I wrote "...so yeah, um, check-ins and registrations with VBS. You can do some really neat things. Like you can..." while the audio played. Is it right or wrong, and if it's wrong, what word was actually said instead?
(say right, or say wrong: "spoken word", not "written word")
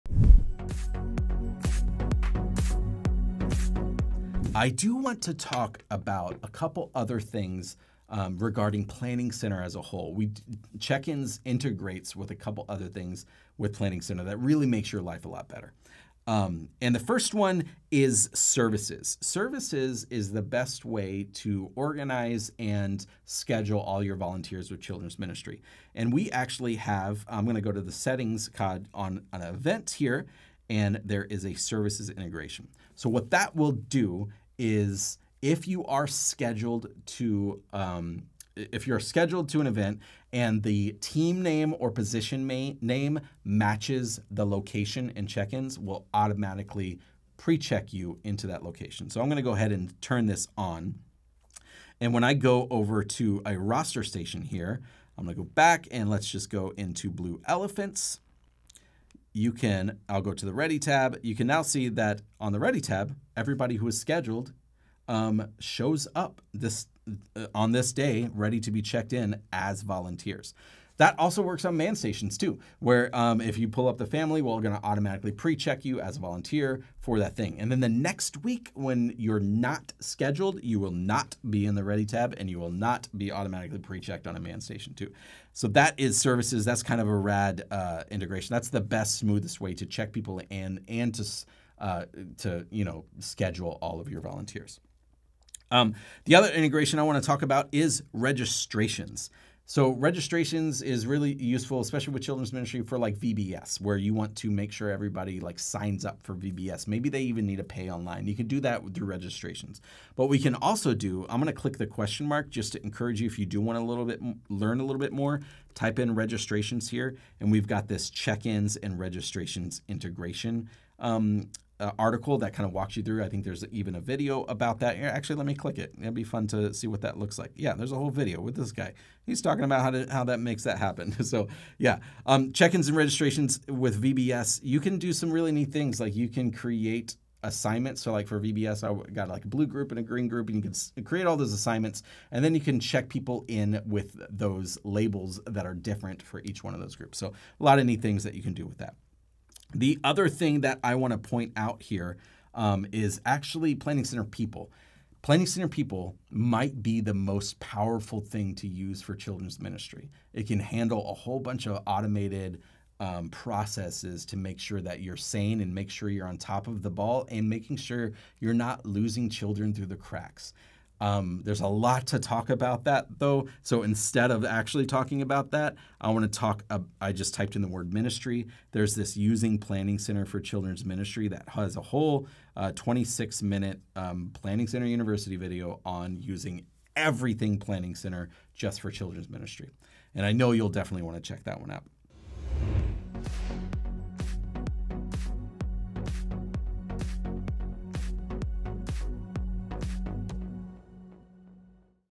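right.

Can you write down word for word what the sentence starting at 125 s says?
It'd be fun to see what that looks like.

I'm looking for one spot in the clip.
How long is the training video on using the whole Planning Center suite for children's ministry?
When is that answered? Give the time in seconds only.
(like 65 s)
182 s.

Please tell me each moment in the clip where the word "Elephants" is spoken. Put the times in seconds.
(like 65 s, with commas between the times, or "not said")
57 s.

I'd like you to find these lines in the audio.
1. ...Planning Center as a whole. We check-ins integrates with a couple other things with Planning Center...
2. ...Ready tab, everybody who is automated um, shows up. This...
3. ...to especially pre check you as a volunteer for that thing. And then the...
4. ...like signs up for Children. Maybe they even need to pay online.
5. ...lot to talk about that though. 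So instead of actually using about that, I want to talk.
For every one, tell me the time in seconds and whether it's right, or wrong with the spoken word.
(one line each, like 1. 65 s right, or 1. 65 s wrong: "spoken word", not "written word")
1. 8 s right
2. 62 s wrong: "scheduled", not "automated"
3. 74 s wrong: "automatically", not "especially"
4. 105 s wrong: "VBS", not "Children"
5. 171 s wrong: "talking", not "using".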